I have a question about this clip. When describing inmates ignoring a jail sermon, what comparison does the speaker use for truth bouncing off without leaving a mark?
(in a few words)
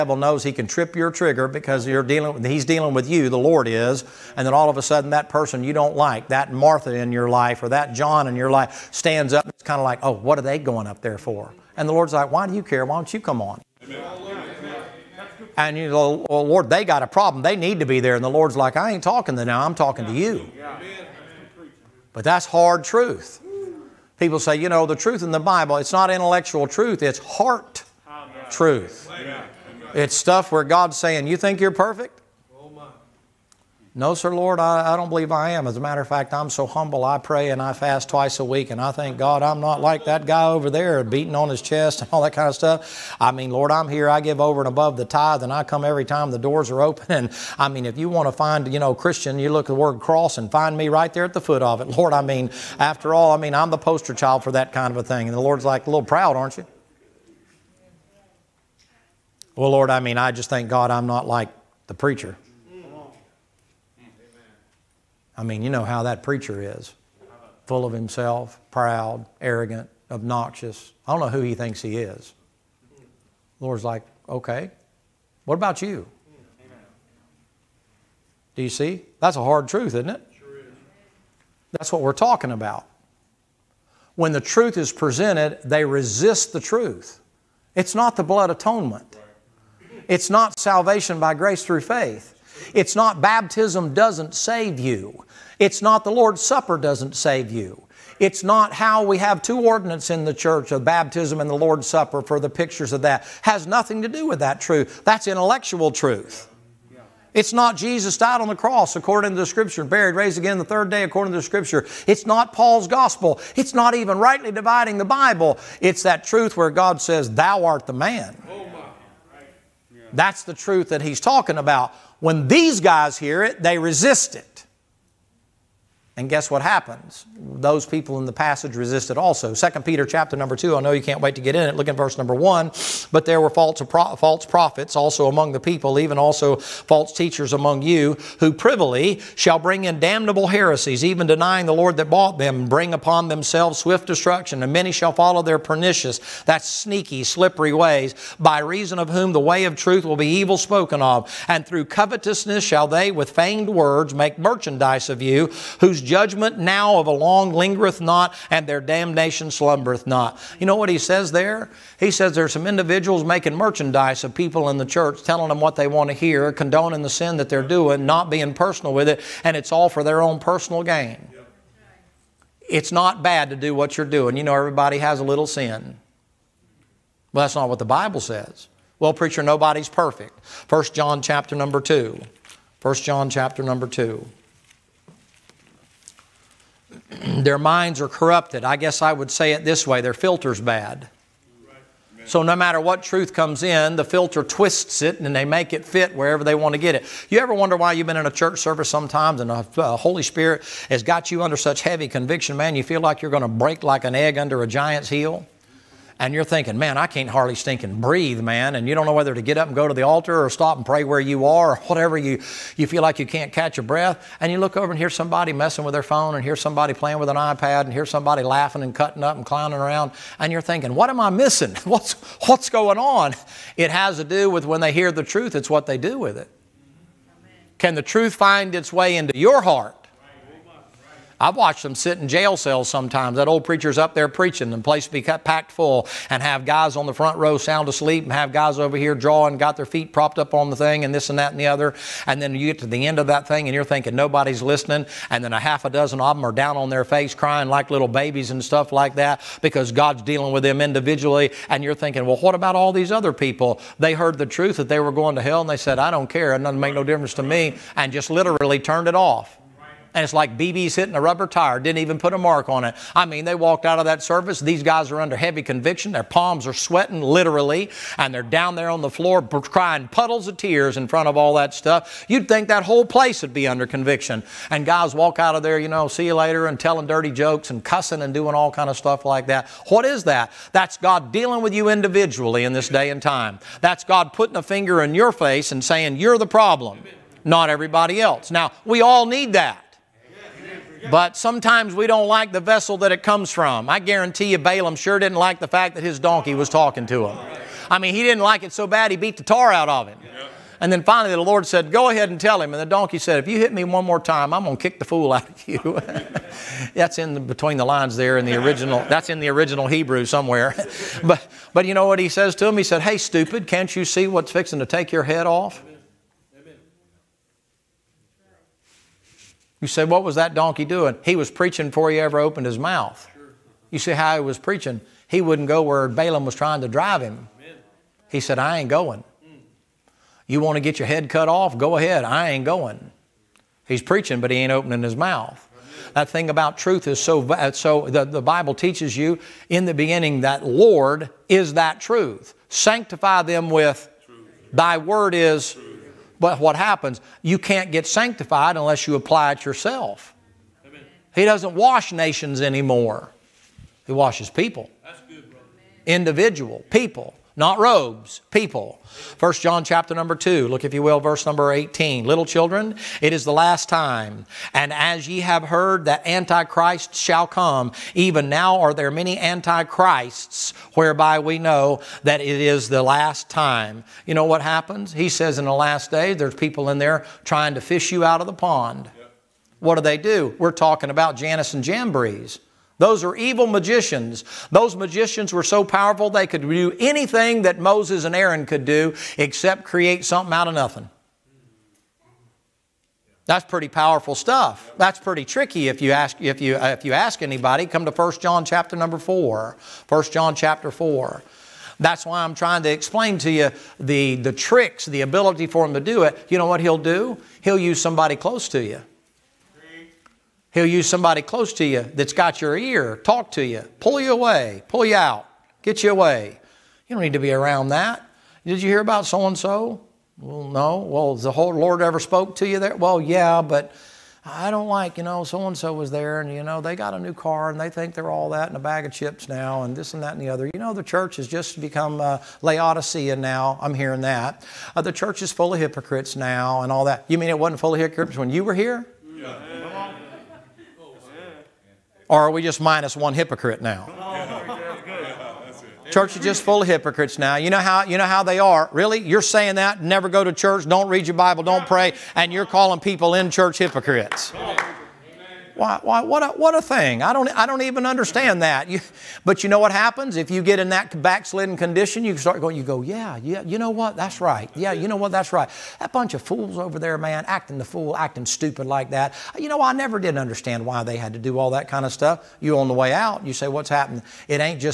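BB's hitting a rubber tire.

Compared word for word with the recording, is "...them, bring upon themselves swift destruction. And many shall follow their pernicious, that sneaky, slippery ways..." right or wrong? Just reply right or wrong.
right.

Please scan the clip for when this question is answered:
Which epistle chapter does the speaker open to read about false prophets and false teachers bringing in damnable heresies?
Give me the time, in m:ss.
2:09.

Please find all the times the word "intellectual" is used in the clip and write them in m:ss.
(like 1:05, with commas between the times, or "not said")
0:26, 1:45.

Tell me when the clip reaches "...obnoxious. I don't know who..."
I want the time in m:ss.
1:10.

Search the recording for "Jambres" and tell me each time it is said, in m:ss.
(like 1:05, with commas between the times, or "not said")
6:21.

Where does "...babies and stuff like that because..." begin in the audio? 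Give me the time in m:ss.
4:08.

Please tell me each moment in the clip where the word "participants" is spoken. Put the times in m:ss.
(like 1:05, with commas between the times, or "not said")
not said.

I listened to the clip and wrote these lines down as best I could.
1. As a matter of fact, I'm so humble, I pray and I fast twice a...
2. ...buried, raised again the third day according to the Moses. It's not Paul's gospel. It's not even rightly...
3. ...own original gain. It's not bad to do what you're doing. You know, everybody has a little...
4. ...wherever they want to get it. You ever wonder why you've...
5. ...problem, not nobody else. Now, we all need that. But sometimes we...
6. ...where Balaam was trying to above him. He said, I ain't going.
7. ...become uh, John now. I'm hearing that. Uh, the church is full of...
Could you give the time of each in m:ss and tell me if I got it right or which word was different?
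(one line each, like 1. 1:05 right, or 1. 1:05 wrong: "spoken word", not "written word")
1. 0:35 right
2. 1:49 wrong: "Scripture", not "Moses"
3. 2:50 wrong: "personal", not "original"
4. 3:16 right
5. 4:46 wrong: "everybody", not "nobody"
6. 5:25 wrong: "drive", not "above"
7. 7:11 wrong: "Laodicea", not "John".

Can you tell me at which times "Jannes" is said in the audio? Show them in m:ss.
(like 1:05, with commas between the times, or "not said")
6:21.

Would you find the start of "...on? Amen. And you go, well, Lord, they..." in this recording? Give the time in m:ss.
0:13.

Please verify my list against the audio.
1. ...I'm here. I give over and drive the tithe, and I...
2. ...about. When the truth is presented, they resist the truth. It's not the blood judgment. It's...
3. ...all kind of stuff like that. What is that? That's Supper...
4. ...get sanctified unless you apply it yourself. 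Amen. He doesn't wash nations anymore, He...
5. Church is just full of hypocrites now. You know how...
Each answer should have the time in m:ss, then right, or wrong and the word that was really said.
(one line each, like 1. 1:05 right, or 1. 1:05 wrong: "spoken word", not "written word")
1. 0:43 wrong: "above", not "drive"
2. 1:22 wrong: "atonement", not "judgment"
3. 4:38 wrong: "God", not "Supper"
4. 5:47 right
5. 7:26 right.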